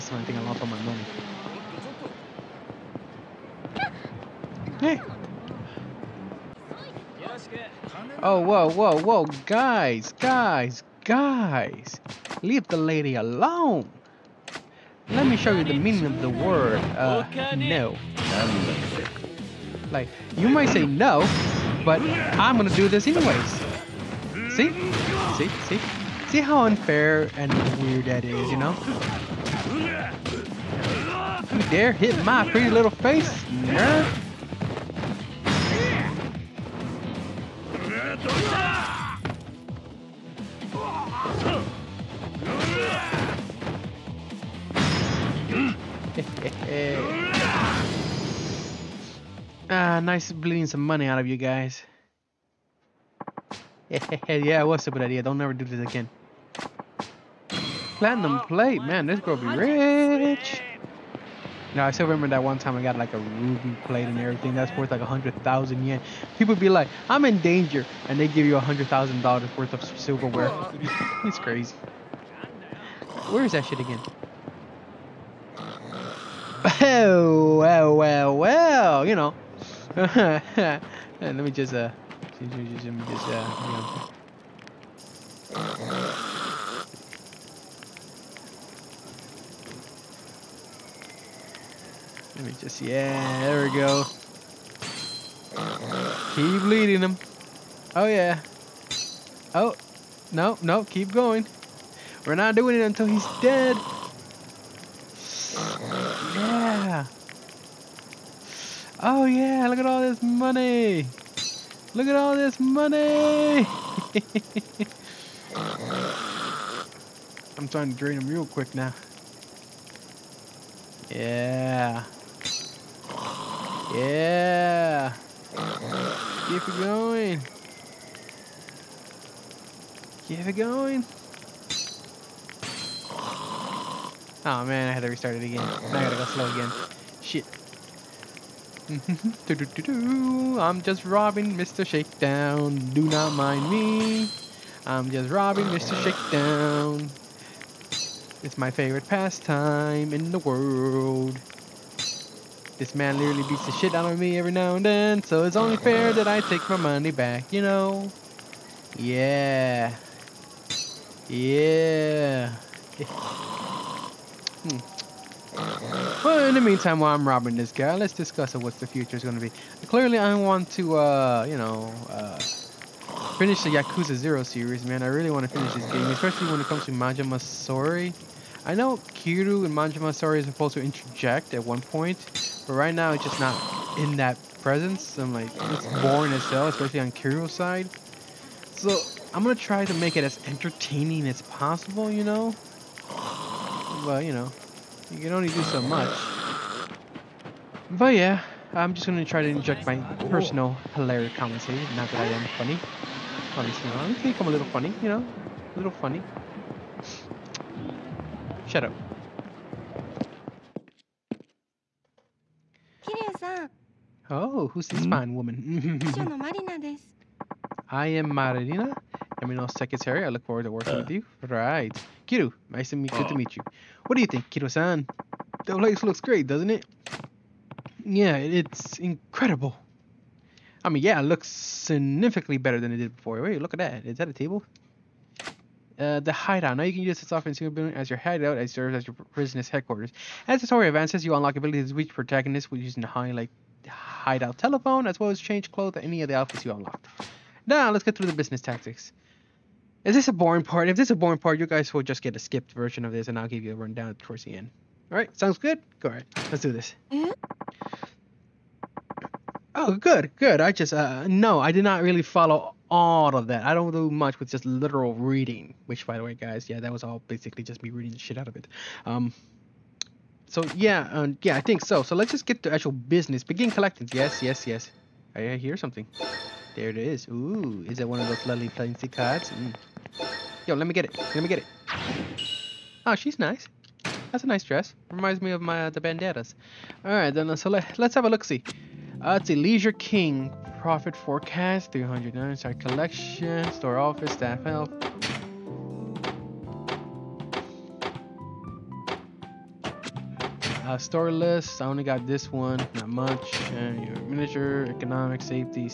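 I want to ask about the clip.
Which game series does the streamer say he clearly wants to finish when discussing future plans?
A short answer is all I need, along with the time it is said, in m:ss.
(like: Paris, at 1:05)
Yakuza 0, at 2:53.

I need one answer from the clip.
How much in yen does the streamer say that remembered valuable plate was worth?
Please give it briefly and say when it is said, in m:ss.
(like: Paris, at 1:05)
100,000 yen, at 1:05.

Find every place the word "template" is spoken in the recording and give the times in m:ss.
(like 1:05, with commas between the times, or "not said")
not said.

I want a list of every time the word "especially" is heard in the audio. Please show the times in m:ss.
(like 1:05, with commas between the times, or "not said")
2:56, 3:06.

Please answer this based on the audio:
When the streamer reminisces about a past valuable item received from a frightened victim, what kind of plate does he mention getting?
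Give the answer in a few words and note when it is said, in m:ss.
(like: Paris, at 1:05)
ruby plate, at 1:03.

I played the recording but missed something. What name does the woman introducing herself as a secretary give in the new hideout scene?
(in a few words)
Marina.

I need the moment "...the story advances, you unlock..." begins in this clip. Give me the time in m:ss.
4:00.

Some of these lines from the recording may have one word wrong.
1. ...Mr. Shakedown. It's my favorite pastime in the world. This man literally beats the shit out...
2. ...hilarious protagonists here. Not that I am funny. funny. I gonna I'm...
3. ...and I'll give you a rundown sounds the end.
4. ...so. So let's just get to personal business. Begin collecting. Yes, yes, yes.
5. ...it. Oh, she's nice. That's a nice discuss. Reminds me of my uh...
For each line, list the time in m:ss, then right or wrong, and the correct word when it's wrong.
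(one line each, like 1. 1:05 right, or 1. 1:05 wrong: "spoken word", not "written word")
1. 2:25 right
2. 3:20 wrong: "comments", not "protagonists"
3. 4:13 wrong: "towards", not "sounds"
4. 4:31 wrong: "actual", not "personal"
5. 4:41 wrong: "dress", not "discuss".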